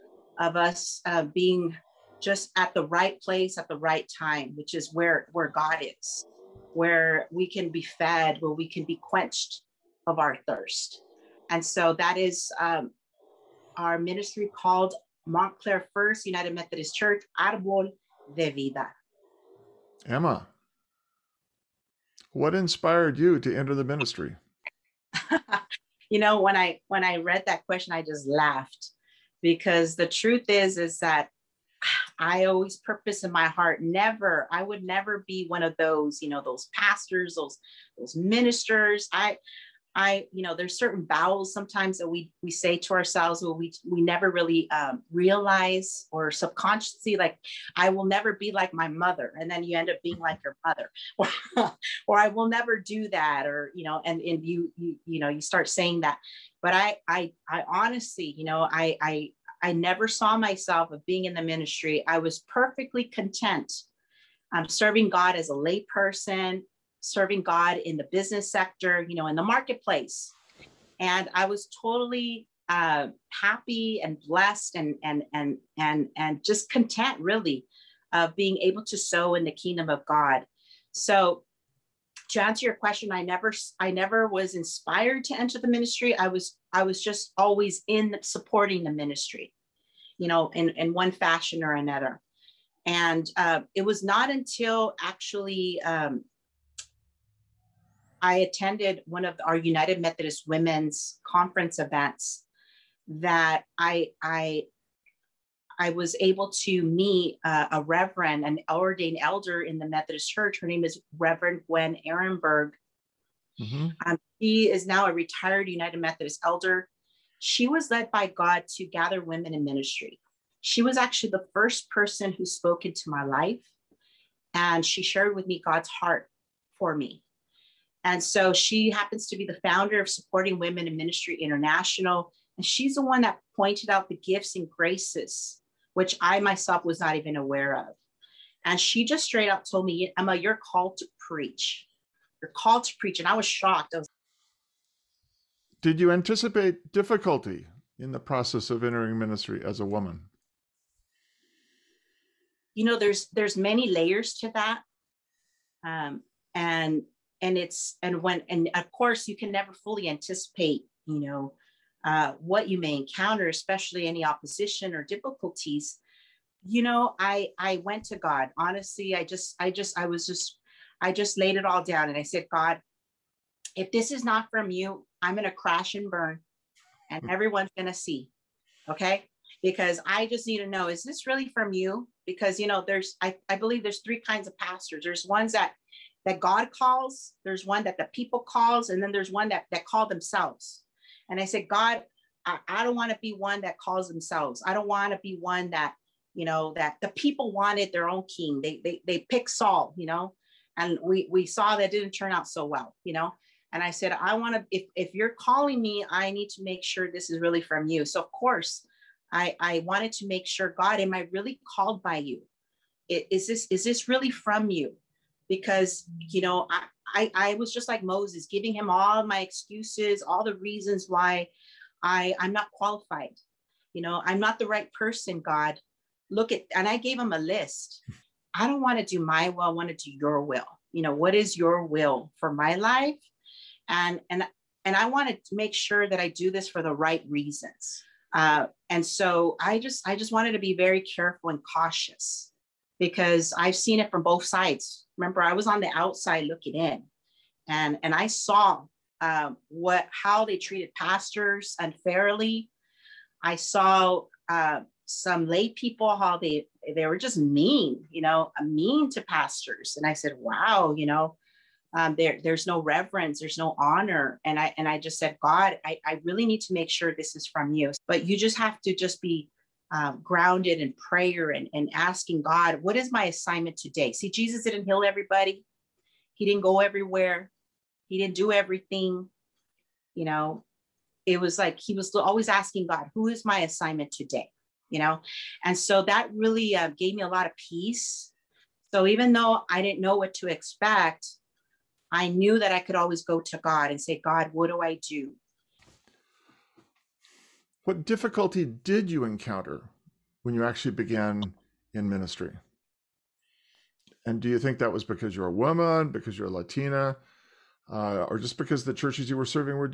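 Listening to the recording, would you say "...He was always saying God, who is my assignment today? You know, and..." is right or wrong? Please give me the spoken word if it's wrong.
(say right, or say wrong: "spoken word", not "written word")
wrong: "asking", not "saying".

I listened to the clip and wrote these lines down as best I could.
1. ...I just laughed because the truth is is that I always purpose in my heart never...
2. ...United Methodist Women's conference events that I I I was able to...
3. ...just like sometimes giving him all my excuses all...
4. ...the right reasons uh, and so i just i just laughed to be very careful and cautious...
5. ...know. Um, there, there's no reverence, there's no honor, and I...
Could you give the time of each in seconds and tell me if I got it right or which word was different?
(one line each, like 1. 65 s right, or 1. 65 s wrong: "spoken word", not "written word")
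1. 27 s right
2. 99 s right
3. 217 s wrong: "moses", not "sometimes"
4. 236 s wrong: "wanted", not "laughed"
5. 261 s right.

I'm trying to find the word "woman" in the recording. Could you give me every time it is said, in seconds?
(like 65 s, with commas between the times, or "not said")
149 s, 305 s.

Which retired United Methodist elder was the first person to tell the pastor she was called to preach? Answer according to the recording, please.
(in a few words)
Reverend Gwen Ehrenberg.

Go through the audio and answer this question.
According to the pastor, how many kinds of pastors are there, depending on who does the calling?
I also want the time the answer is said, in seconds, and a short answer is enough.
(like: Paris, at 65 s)
3, at 184 s.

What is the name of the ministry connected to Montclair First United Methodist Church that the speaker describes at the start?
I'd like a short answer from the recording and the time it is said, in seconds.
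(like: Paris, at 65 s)
Arbol de Vida, at 17 s.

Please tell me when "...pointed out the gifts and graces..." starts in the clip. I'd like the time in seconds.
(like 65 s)
133 s.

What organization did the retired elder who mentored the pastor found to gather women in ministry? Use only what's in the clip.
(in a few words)
Supporting Women in Ministry International.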